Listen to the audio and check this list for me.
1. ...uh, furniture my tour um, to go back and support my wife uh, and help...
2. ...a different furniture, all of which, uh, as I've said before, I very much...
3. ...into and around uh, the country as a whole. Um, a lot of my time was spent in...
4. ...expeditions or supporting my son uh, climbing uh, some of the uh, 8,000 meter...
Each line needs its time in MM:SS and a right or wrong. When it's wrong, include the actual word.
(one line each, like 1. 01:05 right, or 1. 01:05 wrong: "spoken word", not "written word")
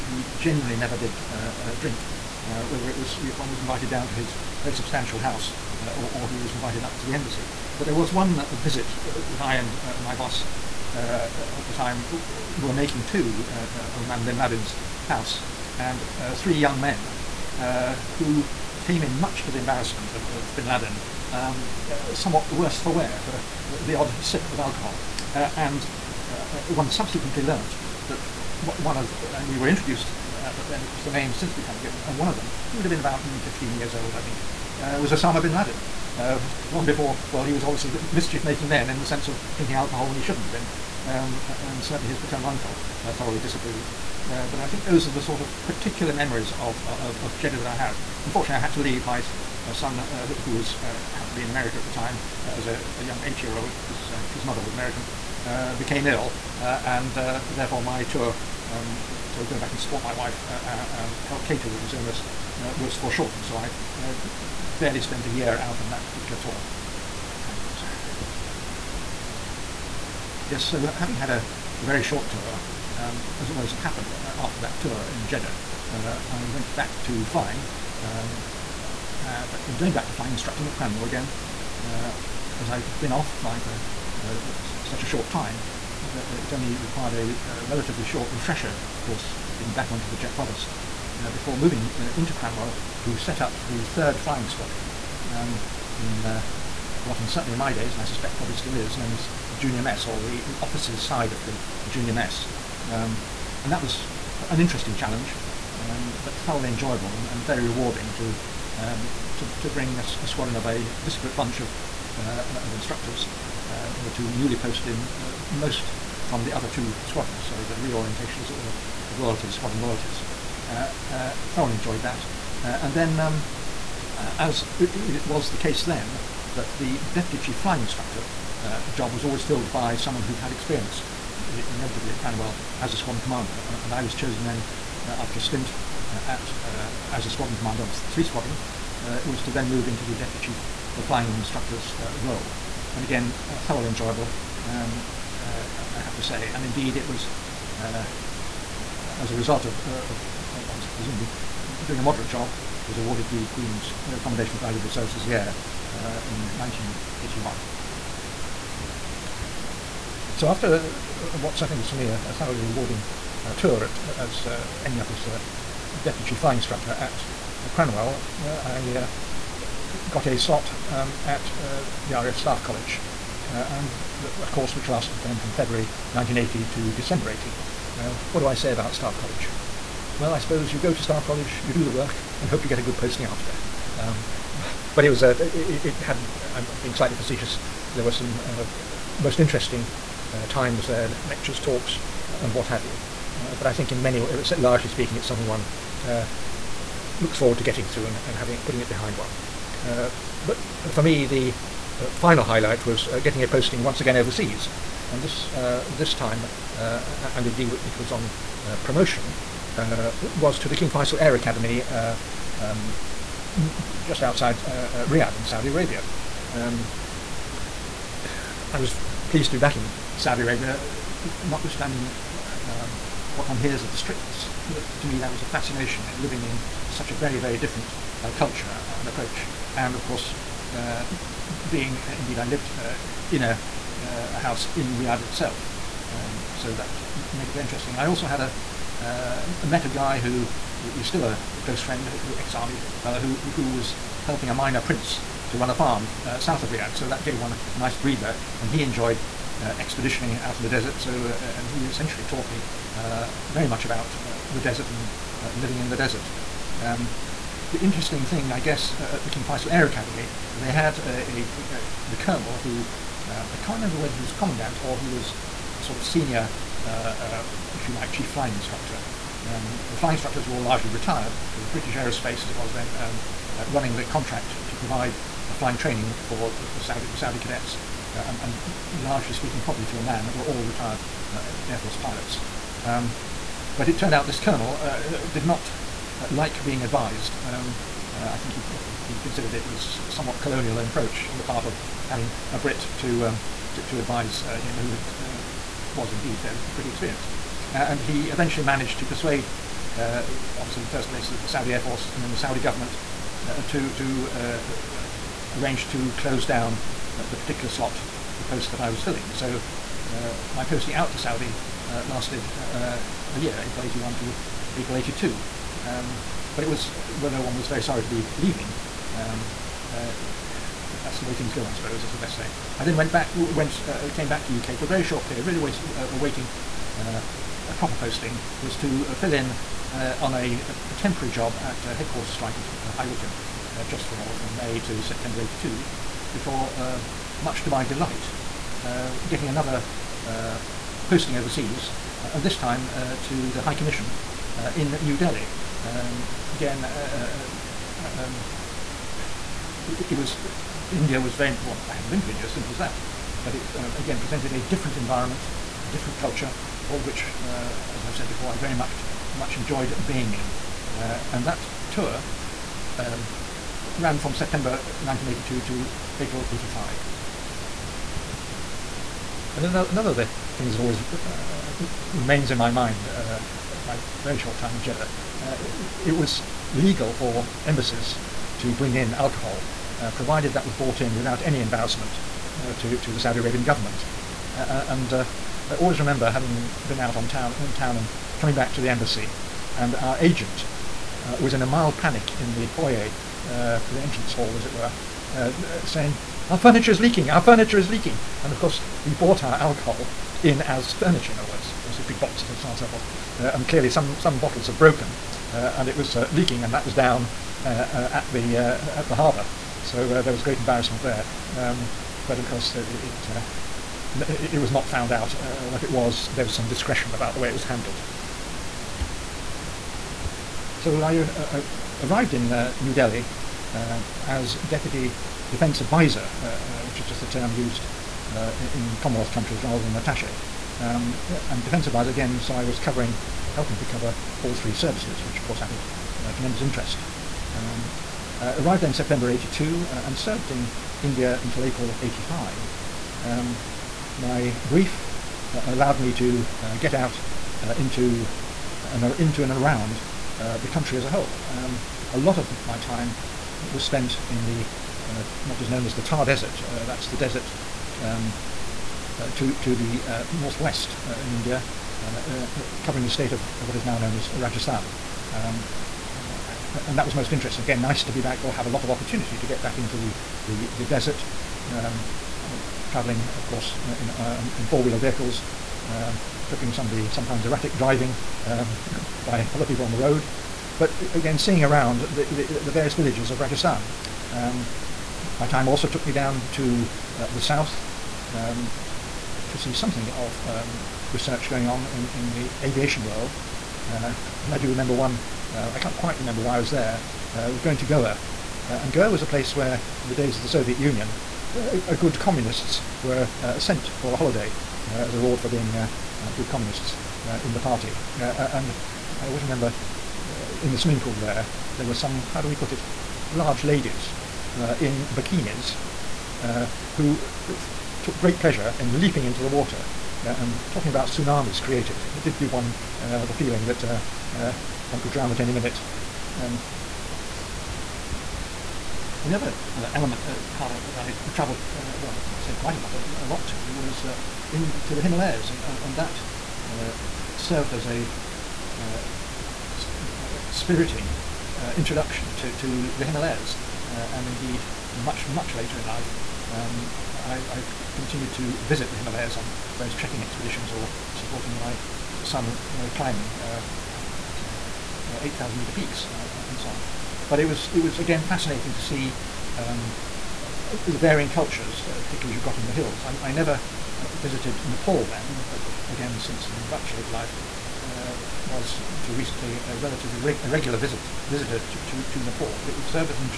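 1. 00:57 wrong: "therefore", not "furniture"
2. 05:55 wrong: "culture", not "furniture"
3. 07:29 right
4. 09:10 right.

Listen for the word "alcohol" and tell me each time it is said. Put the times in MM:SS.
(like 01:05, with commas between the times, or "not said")
00:24, 00:39, 06:19, 06:39.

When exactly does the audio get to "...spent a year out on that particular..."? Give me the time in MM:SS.
01:04.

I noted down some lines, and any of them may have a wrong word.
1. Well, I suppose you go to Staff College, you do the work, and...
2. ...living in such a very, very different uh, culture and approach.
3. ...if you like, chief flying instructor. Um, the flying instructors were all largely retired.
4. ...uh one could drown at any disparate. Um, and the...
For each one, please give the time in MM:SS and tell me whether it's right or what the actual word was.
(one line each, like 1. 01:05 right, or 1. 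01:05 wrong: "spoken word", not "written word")
1. 03:00 right
2. 03:46 right
3. 04:27 right
4. 08:44 wrong: "minute", not "disparate".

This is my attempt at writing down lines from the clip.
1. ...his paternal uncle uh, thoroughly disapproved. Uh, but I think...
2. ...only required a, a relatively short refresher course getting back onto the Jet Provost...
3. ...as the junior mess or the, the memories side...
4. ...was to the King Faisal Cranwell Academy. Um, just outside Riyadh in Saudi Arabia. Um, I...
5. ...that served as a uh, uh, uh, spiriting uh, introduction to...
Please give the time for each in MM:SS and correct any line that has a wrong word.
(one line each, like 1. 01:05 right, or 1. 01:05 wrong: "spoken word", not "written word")
1. 00:42 right
2. 01:26 right
3. 01:39 wrong: "offices", not "memories"
4. 03:30 wrong: "Air", not "Cranwell"
5. 08:55 right.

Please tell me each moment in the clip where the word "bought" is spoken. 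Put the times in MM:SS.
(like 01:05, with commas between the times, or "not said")
06:20, 06:39.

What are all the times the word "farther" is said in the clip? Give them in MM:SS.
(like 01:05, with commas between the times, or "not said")
not said.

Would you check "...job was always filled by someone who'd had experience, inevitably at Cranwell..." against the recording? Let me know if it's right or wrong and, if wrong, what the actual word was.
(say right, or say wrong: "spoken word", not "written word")
right.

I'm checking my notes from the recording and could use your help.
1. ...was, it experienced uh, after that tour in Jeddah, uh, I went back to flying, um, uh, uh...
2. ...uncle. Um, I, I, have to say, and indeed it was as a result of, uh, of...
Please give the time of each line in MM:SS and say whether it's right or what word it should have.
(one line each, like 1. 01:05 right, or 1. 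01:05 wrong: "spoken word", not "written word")
1. 01:13 wrong: "happened", not "experienced"
2. 02:23 wrong: "enjoyable", not "uncle".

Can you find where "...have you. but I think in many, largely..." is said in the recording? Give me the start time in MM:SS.
03:12.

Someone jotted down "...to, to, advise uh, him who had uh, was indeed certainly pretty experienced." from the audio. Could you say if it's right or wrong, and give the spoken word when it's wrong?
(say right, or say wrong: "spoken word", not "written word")
wrong: "fairly", not "certainly".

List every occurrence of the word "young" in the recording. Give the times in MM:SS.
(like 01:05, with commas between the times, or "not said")
00:16, 00:53.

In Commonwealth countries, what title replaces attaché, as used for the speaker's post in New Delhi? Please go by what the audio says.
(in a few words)
Deputy defense advisor.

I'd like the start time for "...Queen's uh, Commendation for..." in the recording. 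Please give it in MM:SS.
02:33.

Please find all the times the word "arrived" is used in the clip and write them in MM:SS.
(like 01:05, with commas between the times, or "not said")
07:02, 07:18.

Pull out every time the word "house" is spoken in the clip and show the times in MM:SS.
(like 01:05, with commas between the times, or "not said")
00:05, 00:15, 03:54.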